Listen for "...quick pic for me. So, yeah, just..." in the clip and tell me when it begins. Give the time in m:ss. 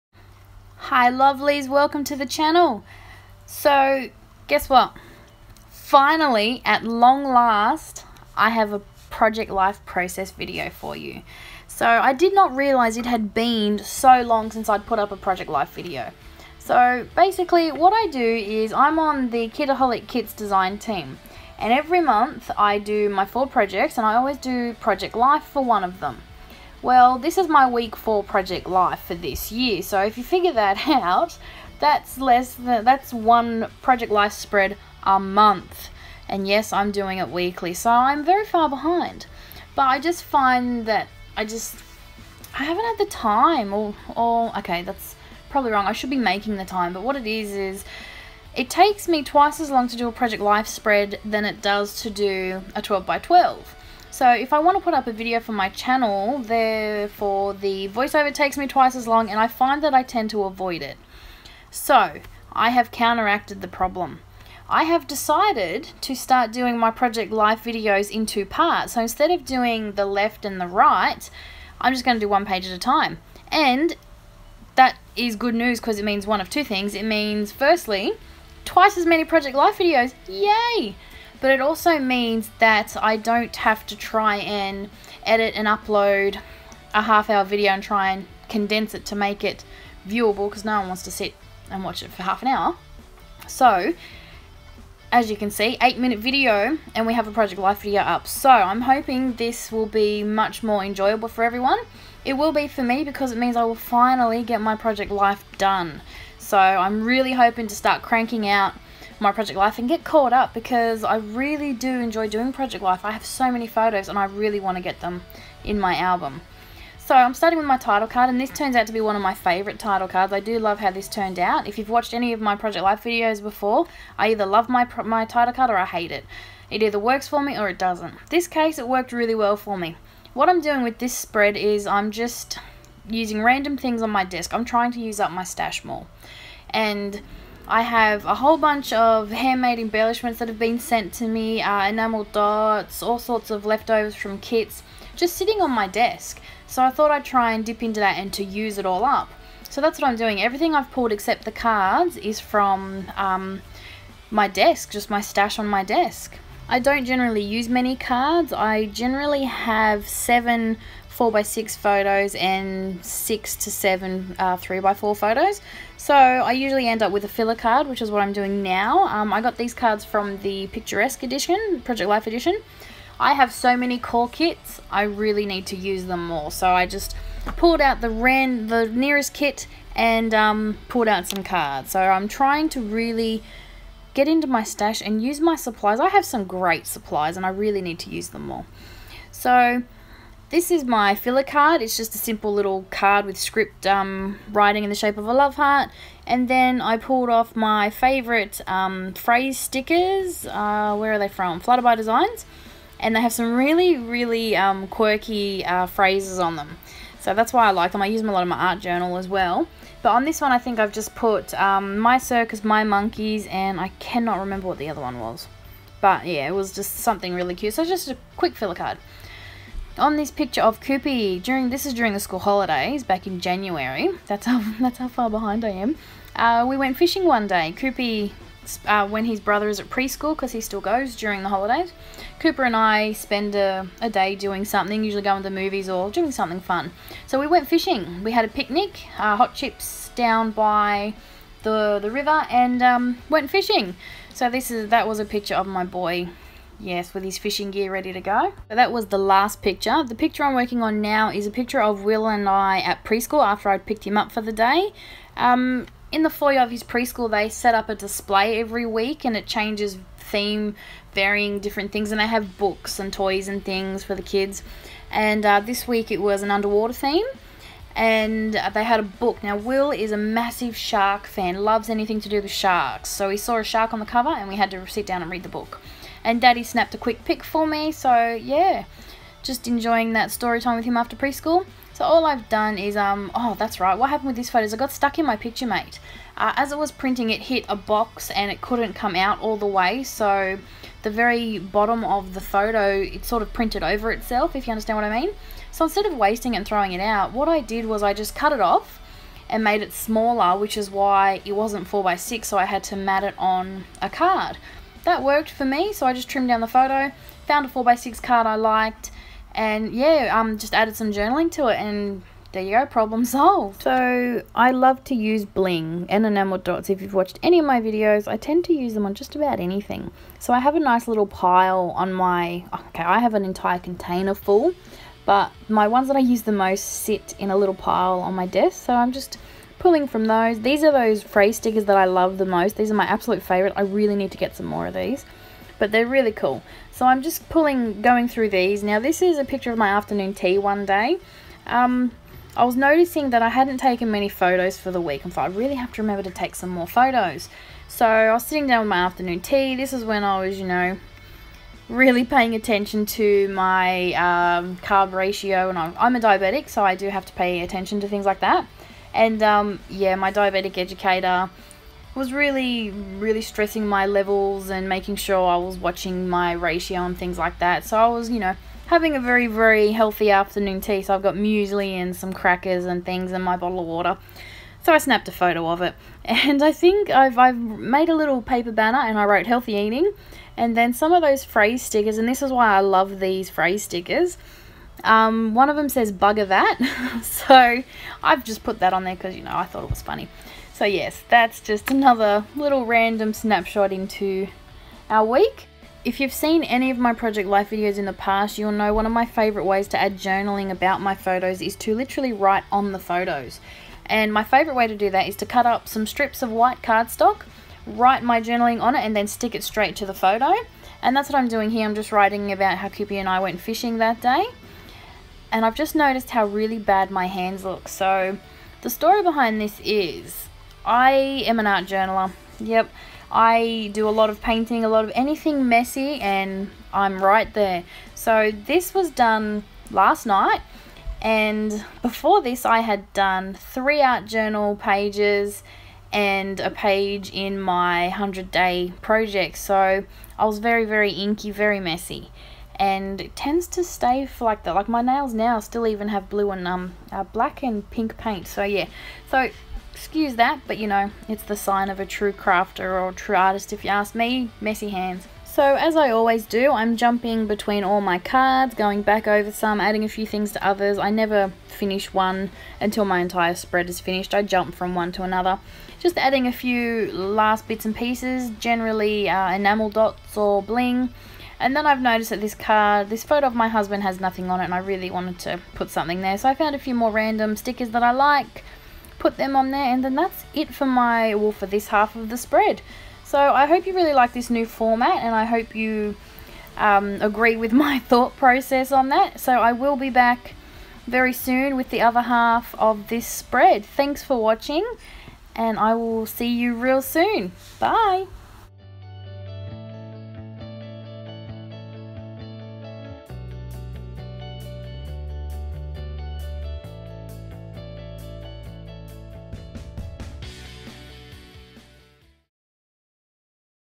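4:36.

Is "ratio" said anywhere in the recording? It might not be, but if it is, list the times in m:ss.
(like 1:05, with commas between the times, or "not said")
5:55, 6:06.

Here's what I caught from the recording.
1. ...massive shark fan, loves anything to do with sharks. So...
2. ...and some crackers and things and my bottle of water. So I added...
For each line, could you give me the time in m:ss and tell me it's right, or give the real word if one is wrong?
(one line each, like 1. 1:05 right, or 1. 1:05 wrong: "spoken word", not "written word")
1. 4:30 right
2. 6:11 wrong: "snapped", not "added".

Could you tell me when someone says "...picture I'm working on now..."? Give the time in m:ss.
4:10.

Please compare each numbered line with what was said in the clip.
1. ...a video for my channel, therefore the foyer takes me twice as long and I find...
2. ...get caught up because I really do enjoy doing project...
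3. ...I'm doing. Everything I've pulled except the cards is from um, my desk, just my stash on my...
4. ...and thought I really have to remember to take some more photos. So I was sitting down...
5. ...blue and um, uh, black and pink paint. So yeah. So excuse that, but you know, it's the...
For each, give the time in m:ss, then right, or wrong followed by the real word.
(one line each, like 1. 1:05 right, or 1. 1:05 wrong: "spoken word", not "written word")
1. 0:55 wrong: "voiceover", not "foyer"
2. 1:49 right
3. 2:30 right
4. 5:45 right
5. 7:26 right.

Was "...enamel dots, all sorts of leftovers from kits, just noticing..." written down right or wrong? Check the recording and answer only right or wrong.
wrong.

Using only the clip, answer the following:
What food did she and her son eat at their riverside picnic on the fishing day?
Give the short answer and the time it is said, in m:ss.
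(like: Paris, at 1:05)
hot chips, at 3:59.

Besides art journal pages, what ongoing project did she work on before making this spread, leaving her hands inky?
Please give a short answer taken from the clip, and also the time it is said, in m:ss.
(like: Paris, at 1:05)
100 day project, at 7:18.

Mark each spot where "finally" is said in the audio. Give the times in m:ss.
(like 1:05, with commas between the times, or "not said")
0:05, 1:43.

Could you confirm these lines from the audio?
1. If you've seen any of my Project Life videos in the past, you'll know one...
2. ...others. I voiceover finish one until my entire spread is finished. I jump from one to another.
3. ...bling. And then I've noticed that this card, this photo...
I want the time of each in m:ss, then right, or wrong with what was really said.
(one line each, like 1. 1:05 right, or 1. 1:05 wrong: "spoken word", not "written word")
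1. 6:36 right
2. 7:40 wrong: "never", not "voiceover"
3. 7:50 right.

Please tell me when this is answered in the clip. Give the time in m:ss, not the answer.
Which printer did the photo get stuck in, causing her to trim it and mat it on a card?
4:45.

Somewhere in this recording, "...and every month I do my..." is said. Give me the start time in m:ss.
0:21.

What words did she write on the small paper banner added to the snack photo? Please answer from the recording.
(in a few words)
healthy eating.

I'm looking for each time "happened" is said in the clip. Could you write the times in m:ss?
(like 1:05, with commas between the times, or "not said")
4:44.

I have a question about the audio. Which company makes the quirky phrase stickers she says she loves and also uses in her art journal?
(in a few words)
Flutter by Designs.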